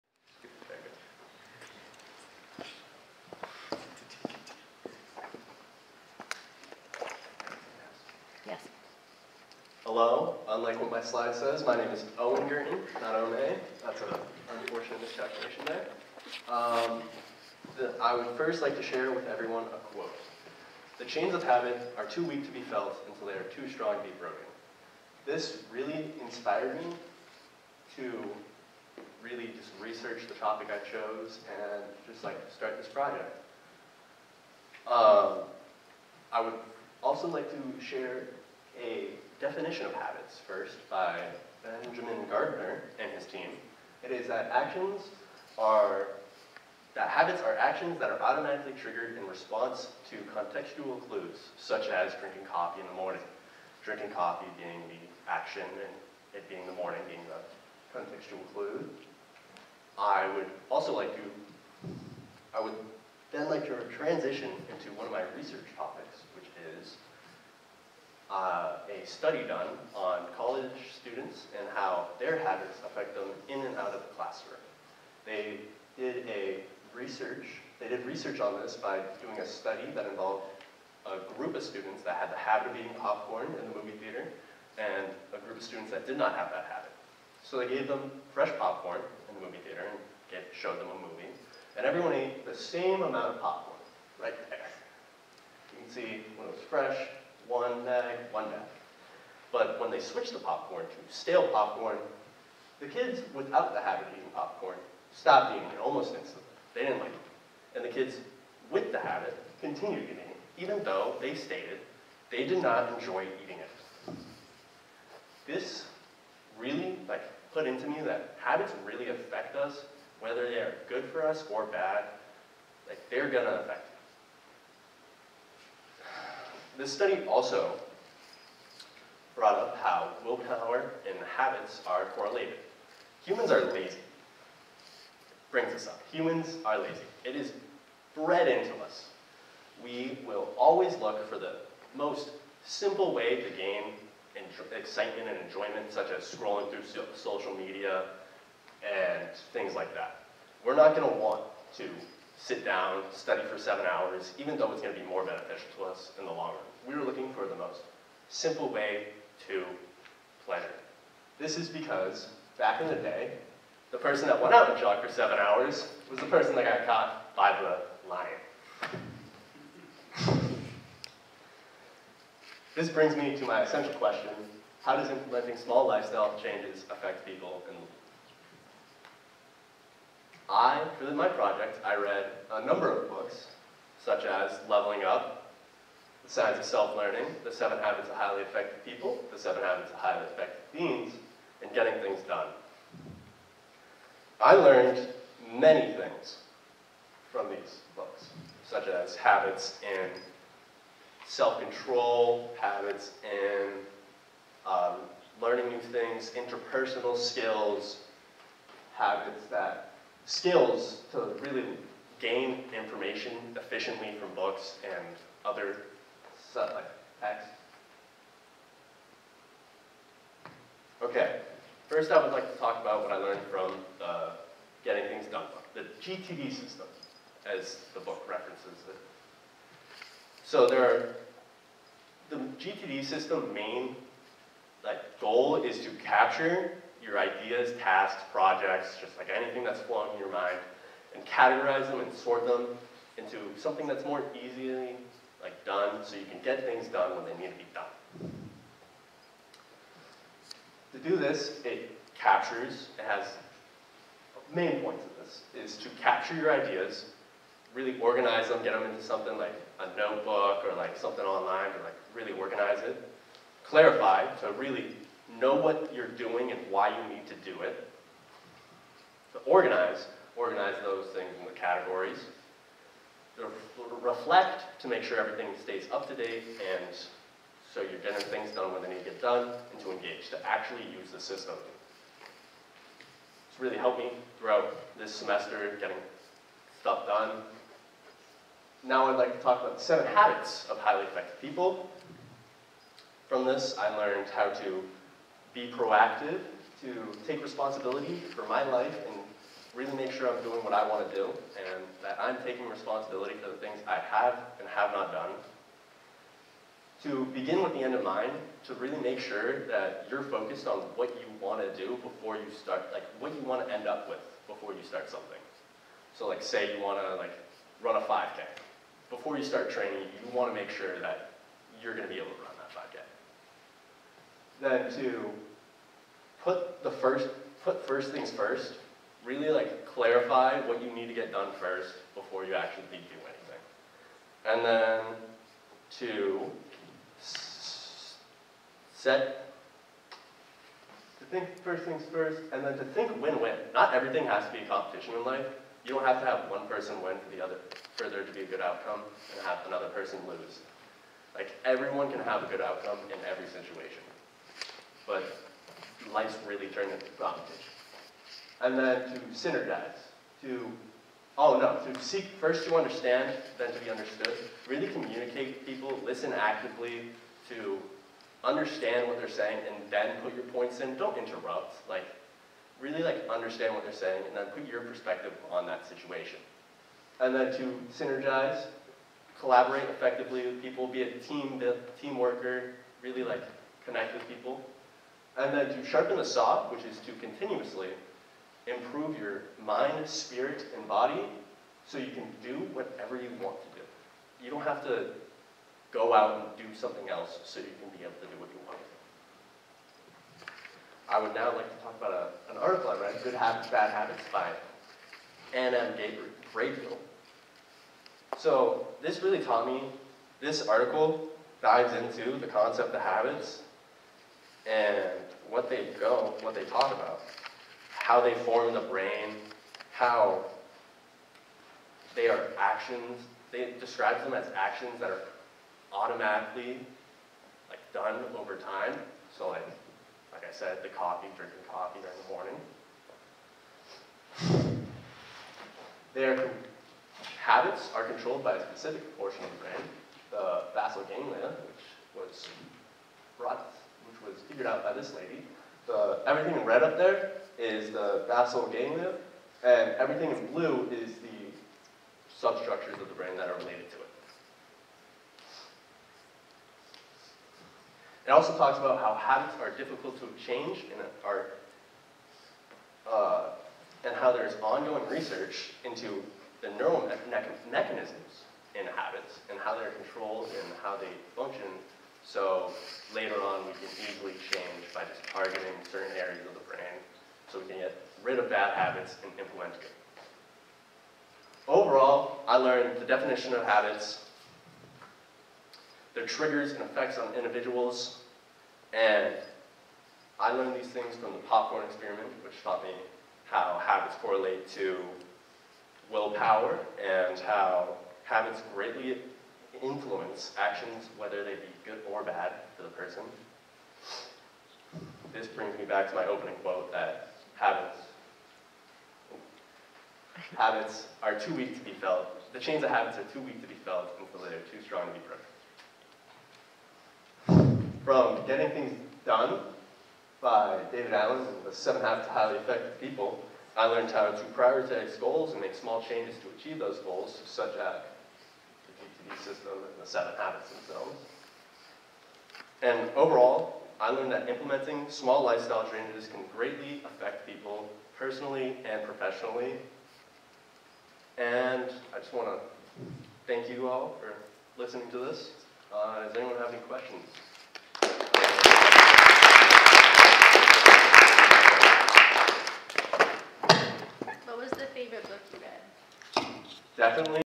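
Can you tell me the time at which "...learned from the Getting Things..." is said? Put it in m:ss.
3:43.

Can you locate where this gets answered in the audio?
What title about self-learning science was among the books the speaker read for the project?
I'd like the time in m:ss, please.
3:04.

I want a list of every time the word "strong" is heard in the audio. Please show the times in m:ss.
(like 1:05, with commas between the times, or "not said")
0:23, 8:34.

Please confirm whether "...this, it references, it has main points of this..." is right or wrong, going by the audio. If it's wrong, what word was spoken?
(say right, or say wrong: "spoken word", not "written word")
wrong: "captures", not "references".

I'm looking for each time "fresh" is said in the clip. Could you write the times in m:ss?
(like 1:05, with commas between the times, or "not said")
1:28, 1:36.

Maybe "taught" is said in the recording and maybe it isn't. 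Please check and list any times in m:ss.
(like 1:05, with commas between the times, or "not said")
6:49, 8:12.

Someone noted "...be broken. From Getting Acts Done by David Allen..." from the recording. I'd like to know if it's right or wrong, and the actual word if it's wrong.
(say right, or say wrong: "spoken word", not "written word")
wrong: "Things", not "Acts".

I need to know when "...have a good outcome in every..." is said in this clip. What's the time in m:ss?
5:52.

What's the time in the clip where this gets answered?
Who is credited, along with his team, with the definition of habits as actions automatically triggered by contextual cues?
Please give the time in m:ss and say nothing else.
0:41.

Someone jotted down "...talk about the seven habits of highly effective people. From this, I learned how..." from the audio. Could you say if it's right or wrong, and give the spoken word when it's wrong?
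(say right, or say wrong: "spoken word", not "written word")
right.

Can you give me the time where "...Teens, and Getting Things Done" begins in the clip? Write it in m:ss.
3:10.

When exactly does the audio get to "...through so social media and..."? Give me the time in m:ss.
2:26.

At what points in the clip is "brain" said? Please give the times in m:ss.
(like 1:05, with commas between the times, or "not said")
6:58, 7:19, 7:33, 7:56.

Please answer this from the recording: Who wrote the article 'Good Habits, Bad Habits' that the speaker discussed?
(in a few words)
Ann Graybiel.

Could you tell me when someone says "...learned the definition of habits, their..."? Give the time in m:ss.
8:02.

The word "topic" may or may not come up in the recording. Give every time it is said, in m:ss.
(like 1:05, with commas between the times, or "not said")
0:30, 1:05.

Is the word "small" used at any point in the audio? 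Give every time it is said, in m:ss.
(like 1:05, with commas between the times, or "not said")
2:55, 8:45, 8:55.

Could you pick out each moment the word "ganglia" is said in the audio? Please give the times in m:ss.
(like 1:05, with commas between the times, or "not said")
7:21, 7:28.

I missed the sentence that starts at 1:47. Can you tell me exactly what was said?
And the kids with the habit continued eating it, even though they stated they did not enjoy eating it.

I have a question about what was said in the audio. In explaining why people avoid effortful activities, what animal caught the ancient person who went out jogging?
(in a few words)
the lion.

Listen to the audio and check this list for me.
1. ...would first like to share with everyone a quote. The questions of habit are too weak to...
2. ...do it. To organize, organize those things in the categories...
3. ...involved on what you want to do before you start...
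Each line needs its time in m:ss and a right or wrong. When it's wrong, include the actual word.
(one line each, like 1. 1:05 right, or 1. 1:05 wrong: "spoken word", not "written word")
1. 0:18 wrong: "chains", not "questions"
2. 4:27 right
3. 5:10 wrong: "focused", not "involved".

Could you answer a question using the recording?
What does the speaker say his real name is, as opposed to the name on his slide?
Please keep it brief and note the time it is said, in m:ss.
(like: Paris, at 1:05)
Owen Gurton, at 0:12.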